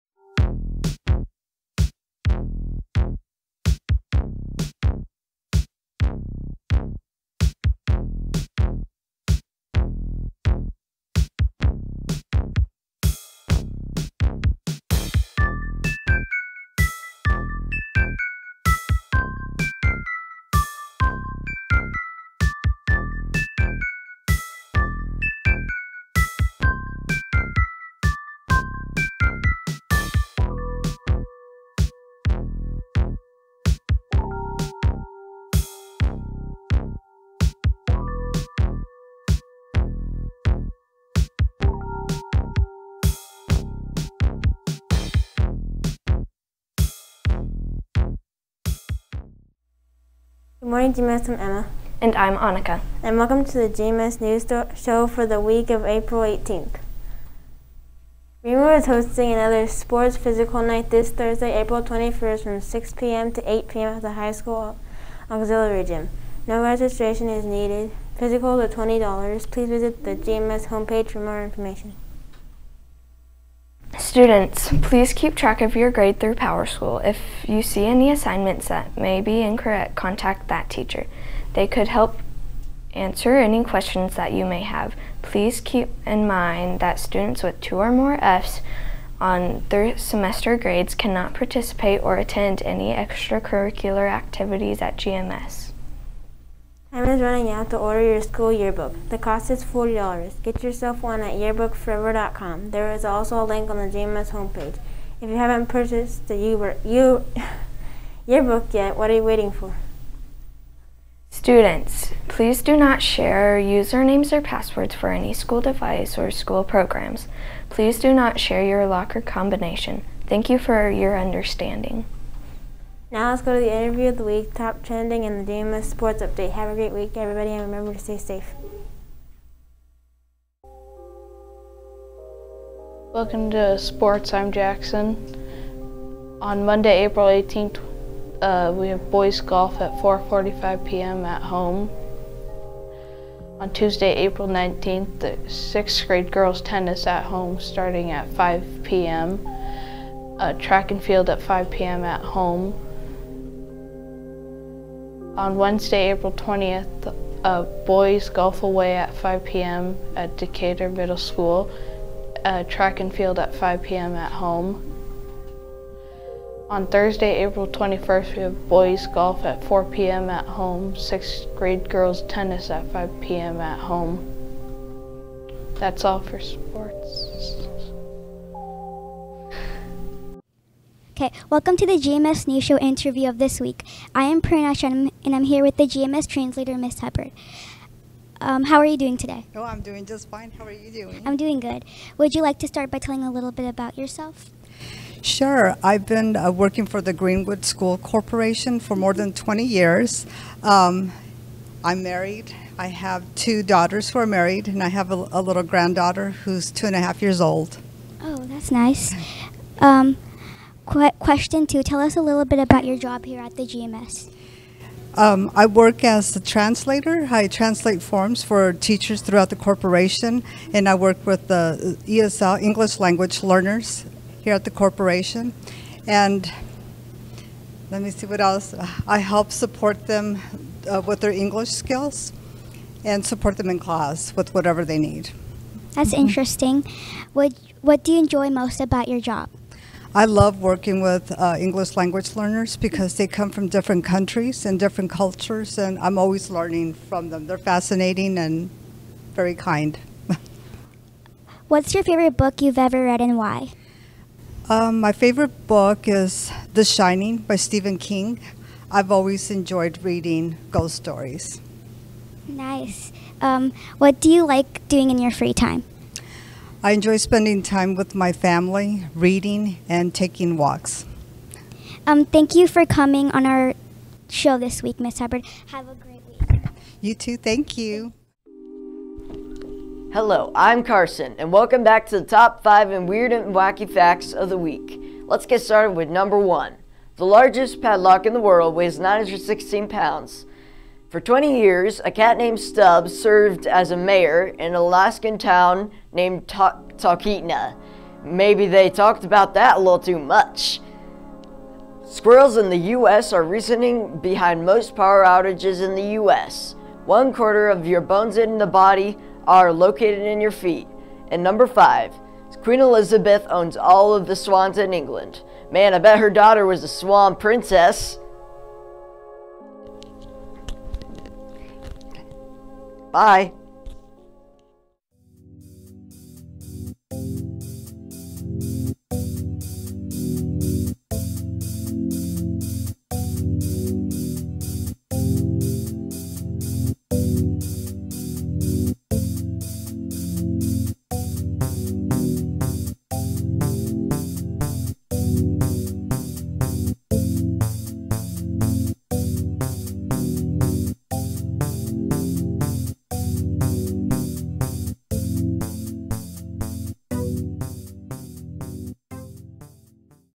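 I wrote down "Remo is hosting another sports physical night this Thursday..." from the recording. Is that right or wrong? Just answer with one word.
right.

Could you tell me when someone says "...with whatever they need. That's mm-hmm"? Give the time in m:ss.
3:54.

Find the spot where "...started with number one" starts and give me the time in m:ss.
4:45.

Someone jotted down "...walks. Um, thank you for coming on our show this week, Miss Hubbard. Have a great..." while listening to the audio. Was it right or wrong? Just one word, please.
right.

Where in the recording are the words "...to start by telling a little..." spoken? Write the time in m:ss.
3:12.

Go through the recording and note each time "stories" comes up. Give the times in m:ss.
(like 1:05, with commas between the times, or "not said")
4:20.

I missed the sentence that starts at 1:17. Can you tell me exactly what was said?
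If you see any assignments that may be incorrect, contact that teacher.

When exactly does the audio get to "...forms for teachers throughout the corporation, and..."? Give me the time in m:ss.
3:38.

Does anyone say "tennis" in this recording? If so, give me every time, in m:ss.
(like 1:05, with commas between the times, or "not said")
2:26, 2:52.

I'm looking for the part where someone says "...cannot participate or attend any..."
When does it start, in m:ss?
1:30.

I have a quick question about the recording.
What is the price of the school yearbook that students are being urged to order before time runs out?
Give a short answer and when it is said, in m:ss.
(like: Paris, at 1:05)
$40, at 1:39.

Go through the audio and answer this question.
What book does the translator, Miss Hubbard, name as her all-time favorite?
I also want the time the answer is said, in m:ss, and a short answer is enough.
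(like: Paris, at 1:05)
The Shining, at 4:16.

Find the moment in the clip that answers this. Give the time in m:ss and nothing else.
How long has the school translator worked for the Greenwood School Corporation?
3:18.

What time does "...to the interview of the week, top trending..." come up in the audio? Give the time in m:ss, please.
2:03.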